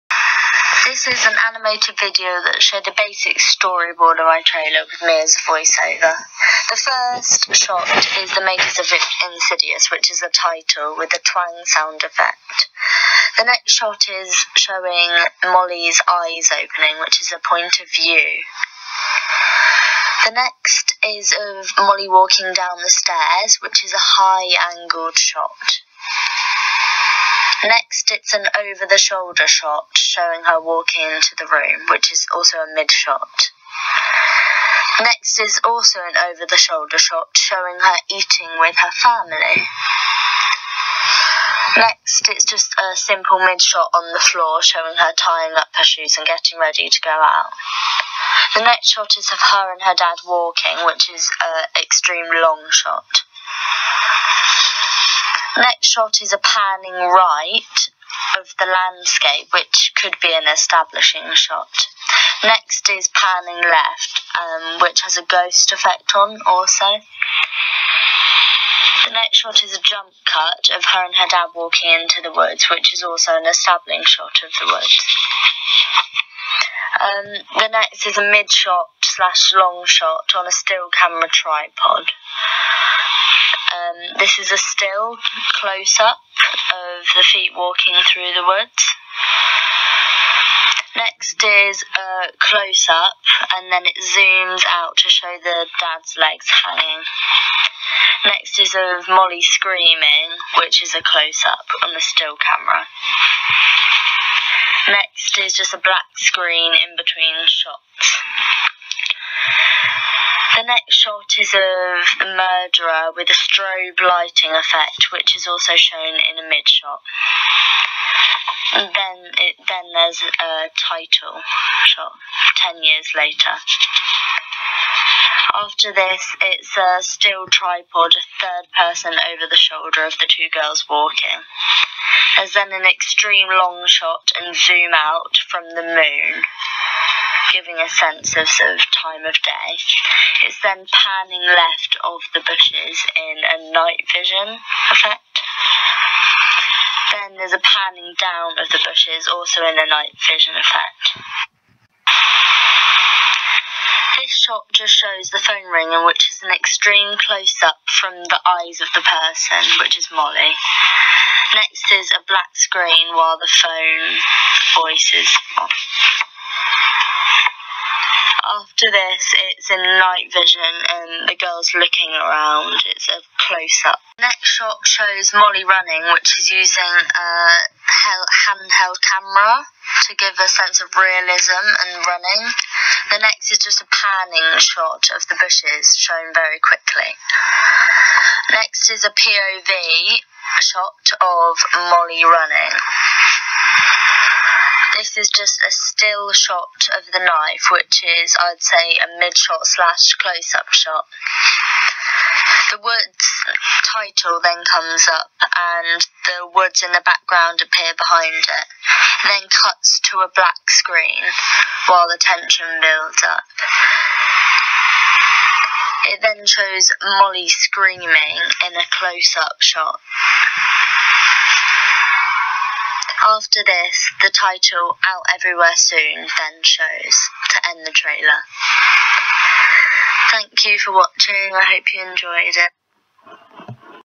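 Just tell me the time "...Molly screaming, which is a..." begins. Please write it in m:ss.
1:39.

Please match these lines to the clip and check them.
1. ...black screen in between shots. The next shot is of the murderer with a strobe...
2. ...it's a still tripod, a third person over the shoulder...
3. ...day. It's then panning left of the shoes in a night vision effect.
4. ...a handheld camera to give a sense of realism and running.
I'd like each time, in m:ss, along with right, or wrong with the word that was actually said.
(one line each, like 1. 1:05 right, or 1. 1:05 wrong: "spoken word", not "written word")
1. 1:45 right
2. 2:06 right
3. 2:19 wrong: "bushes", not "shoes"
4. 2:57 right.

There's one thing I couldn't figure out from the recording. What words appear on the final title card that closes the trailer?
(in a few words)
Out Everywhere Soon.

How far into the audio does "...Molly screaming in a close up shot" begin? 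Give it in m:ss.
3:37.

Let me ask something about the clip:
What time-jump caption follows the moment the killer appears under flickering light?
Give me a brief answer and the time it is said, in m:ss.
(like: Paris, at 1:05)
10 years later, at 2:02.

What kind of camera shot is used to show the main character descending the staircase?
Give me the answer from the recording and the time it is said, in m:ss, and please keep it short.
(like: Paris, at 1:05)
High angled shot, at 0:23.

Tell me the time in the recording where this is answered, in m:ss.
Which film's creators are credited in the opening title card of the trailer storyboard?
0:09.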